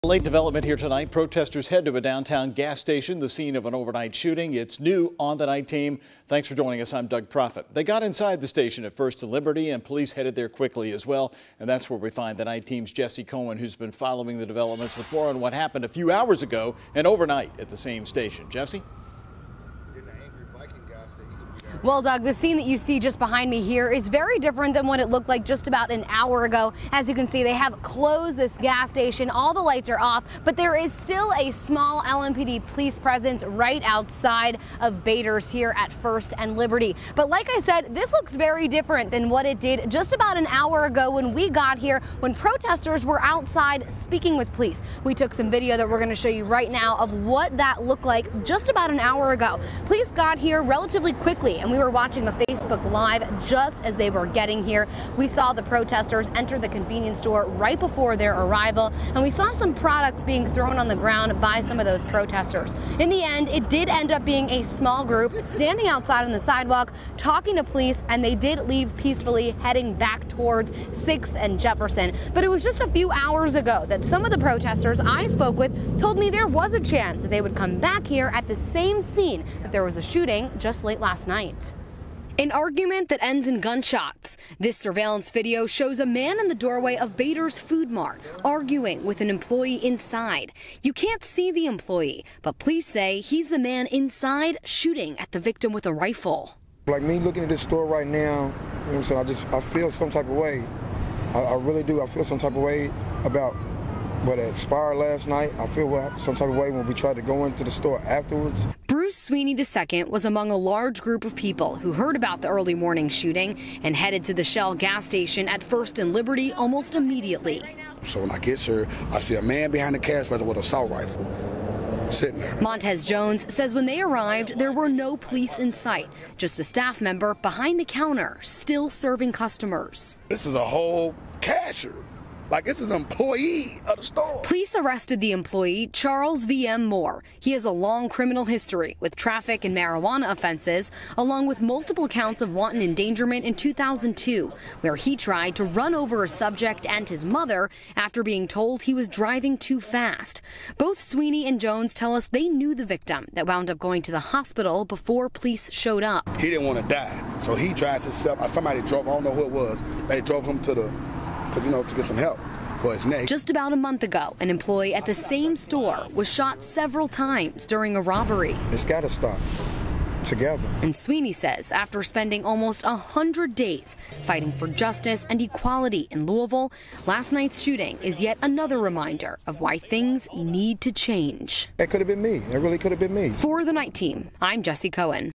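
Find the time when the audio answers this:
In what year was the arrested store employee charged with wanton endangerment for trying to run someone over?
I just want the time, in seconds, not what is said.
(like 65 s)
143 s.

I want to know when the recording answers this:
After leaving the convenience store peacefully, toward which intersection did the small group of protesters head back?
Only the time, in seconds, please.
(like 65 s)
70 s.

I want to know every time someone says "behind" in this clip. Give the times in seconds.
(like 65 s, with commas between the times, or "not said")
23 s, 119 s, 127 s.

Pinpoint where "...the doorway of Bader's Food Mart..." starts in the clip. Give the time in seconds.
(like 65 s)
86 s.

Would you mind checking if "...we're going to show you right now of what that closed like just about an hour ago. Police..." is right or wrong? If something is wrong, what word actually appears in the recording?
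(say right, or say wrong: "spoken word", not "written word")
wrong: "looked", not "closed".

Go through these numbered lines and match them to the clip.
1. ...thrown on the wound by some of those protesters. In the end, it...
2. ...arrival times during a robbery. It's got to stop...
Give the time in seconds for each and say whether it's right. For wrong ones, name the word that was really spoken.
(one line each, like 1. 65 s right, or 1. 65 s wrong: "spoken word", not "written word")
1. 60 s wrong: "ground", not "wound"
2. 166 s wrong: "several", not "arrival".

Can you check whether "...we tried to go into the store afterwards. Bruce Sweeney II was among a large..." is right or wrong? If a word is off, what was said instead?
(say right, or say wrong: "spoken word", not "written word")
right.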